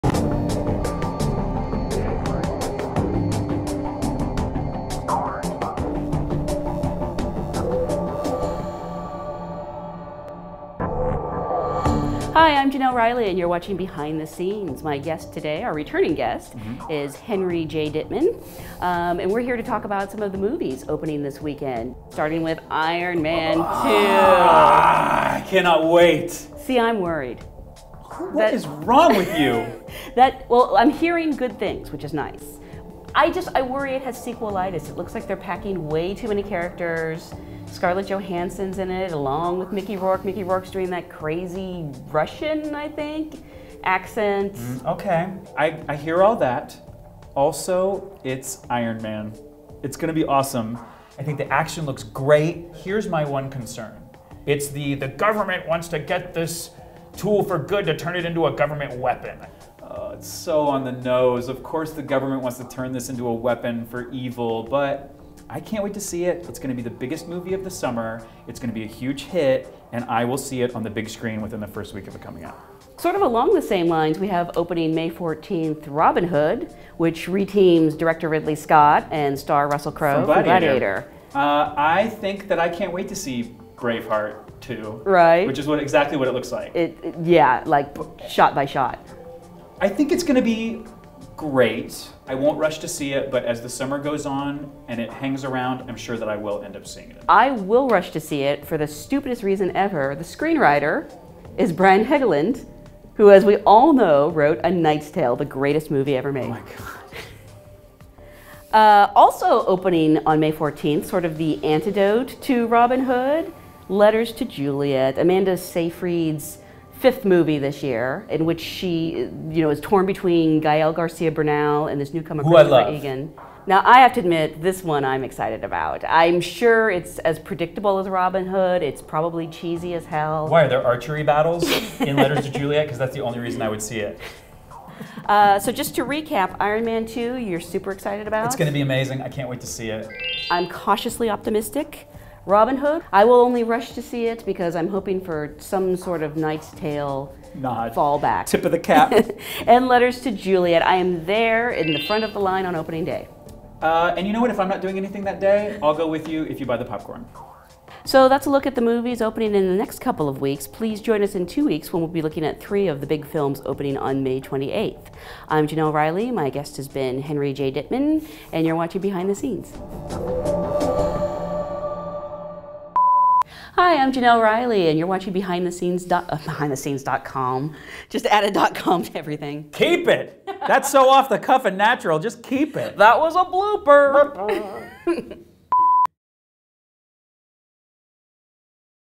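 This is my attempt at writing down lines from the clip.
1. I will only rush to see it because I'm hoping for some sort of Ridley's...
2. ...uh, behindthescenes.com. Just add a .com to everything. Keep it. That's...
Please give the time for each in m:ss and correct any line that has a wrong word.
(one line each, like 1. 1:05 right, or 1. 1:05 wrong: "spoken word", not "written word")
1. 2:23 wrong: "Knight", not "Ridley"
2. 2:56 right.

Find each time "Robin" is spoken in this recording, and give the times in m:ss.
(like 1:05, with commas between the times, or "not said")
1:15, 1:52, 2:08, 2:22.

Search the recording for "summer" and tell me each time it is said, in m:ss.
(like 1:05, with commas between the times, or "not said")
1:07, 1:33.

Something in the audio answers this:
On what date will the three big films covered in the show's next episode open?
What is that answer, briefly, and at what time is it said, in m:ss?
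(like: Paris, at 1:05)
May 28th, at 2:44.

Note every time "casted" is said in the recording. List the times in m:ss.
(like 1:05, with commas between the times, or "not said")
not said.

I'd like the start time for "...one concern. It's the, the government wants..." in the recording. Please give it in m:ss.
0:53.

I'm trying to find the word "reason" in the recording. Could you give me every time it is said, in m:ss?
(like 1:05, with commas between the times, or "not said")
1:39, 2:13.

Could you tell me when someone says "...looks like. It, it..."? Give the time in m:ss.
1:26.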